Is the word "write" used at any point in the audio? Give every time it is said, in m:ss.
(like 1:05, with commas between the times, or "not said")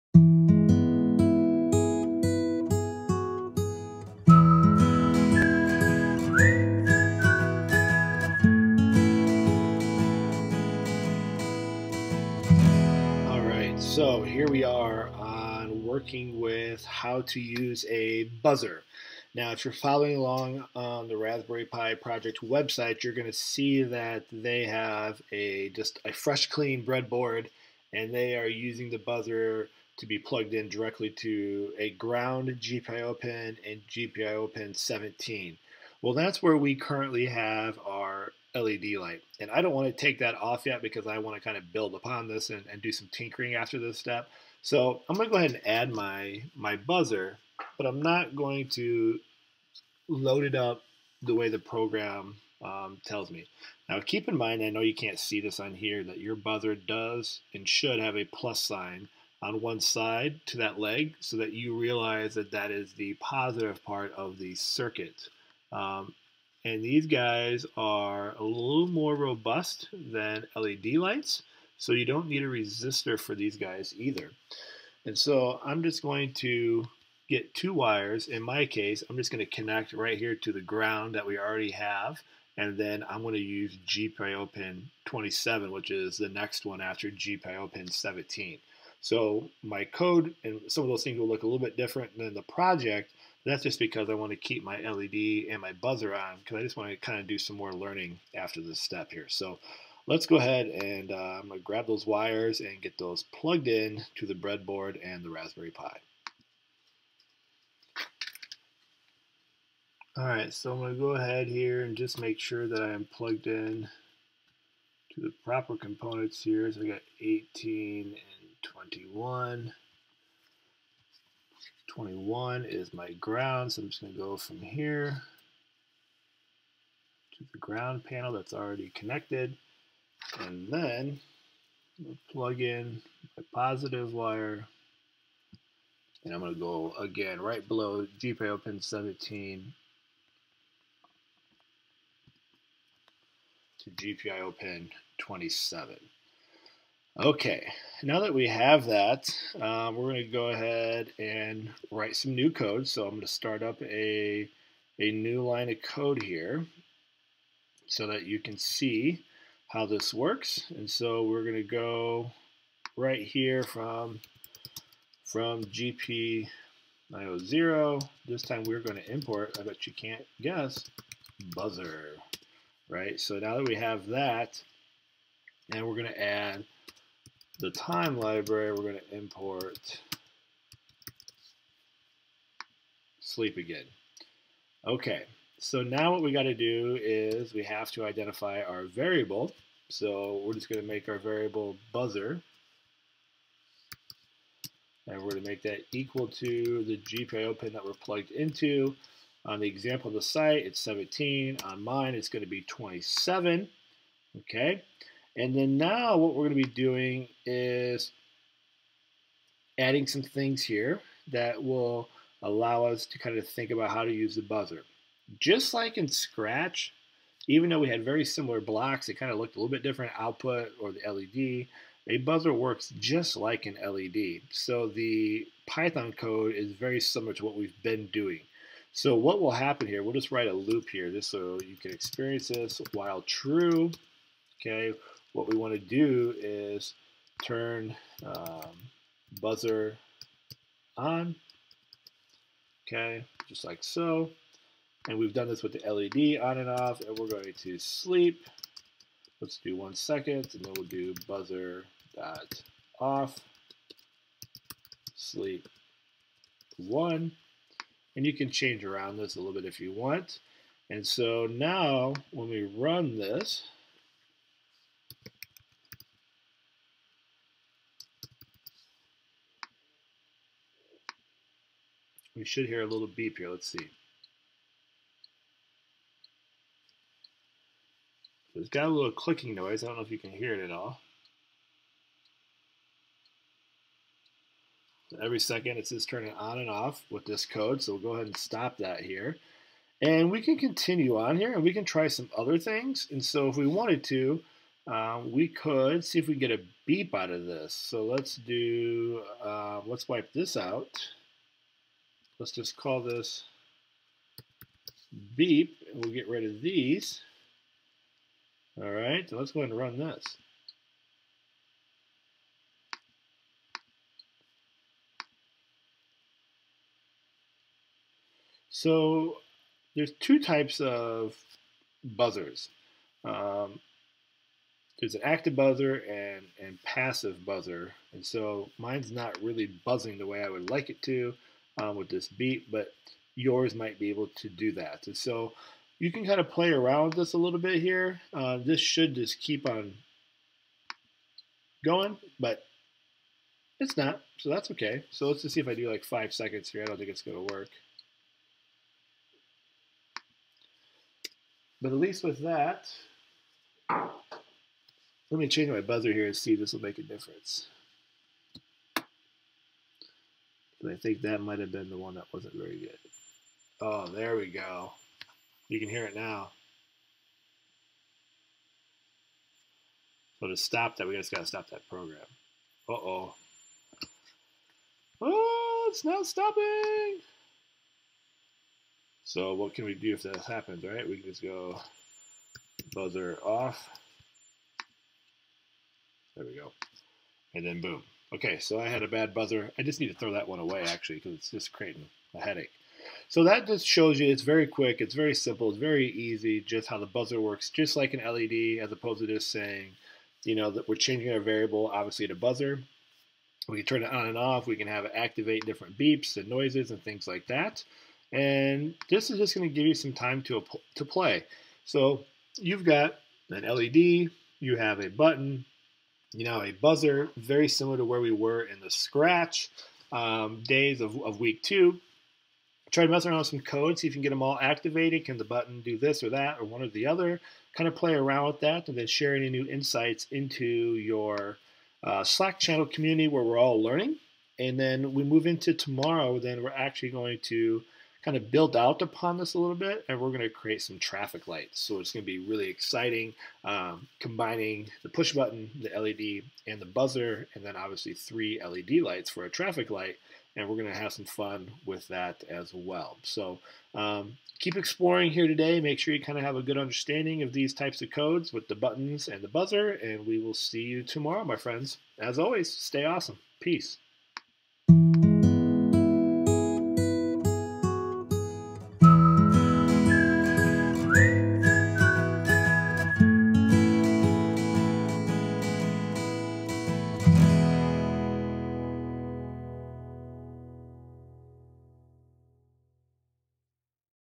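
2:31, 3:50.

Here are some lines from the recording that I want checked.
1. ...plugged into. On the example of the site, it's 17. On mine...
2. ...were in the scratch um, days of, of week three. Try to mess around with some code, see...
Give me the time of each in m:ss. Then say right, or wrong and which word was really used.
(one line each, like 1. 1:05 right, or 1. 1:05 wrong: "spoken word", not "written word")
1. 3:17 right
2. 6:58 wrong: "two", not "three".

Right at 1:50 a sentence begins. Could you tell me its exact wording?
Alright, so I'm going to go ahead here and just make sure that I am plugged in to the proper components here.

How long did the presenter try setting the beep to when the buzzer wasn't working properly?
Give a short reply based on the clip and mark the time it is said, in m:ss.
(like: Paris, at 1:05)
5 seconds, at 5:46.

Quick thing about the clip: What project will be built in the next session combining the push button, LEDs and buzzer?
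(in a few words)
traffic lights.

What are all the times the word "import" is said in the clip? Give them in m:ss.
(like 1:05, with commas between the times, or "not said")
2:49, 2:59.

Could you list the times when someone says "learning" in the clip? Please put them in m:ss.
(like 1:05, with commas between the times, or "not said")
1:37, 7:13.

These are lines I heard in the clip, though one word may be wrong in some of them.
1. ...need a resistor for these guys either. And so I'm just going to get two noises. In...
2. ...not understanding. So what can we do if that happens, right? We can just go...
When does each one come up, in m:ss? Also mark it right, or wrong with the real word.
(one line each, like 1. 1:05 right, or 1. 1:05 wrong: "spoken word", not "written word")
1. 1:12 wrong: "wires", not "noises"
2. 6:16 wrong: "stopping", not "understanding".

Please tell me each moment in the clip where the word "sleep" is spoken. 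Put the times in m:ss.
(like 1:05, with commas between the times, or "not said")
3:03, 4:07, 4:15.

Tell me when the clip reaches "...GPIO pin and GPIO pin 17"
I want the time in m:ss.
0:32.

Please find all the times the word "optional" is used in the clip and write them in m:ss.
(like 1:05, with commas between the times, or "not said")
not said.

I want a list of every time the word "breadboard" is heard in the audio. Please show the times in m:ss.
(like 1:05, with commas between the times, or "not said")
0:26, 1:44.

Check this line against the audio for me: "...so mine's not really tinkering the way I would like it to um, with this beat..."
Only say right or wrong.
wrong.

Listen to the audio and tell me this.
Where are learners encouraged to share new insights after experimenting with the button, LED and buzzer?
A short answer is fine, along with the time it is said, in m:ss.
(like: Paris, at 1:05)
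Slack channel, at 7:12.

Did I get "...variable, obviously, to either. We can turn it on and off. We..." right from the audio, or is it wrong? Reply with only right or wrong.
wrong.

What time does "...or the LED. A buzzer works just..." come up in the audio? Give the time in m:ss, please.
3:40.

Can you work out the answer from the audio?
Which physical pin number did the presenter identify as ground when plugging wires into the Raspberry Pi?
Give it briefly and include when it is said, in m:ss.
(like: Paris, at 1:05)
21, at 2:01.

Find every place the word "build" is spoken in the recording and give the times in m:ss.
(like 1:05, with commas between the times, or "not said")
0:41, 7:18.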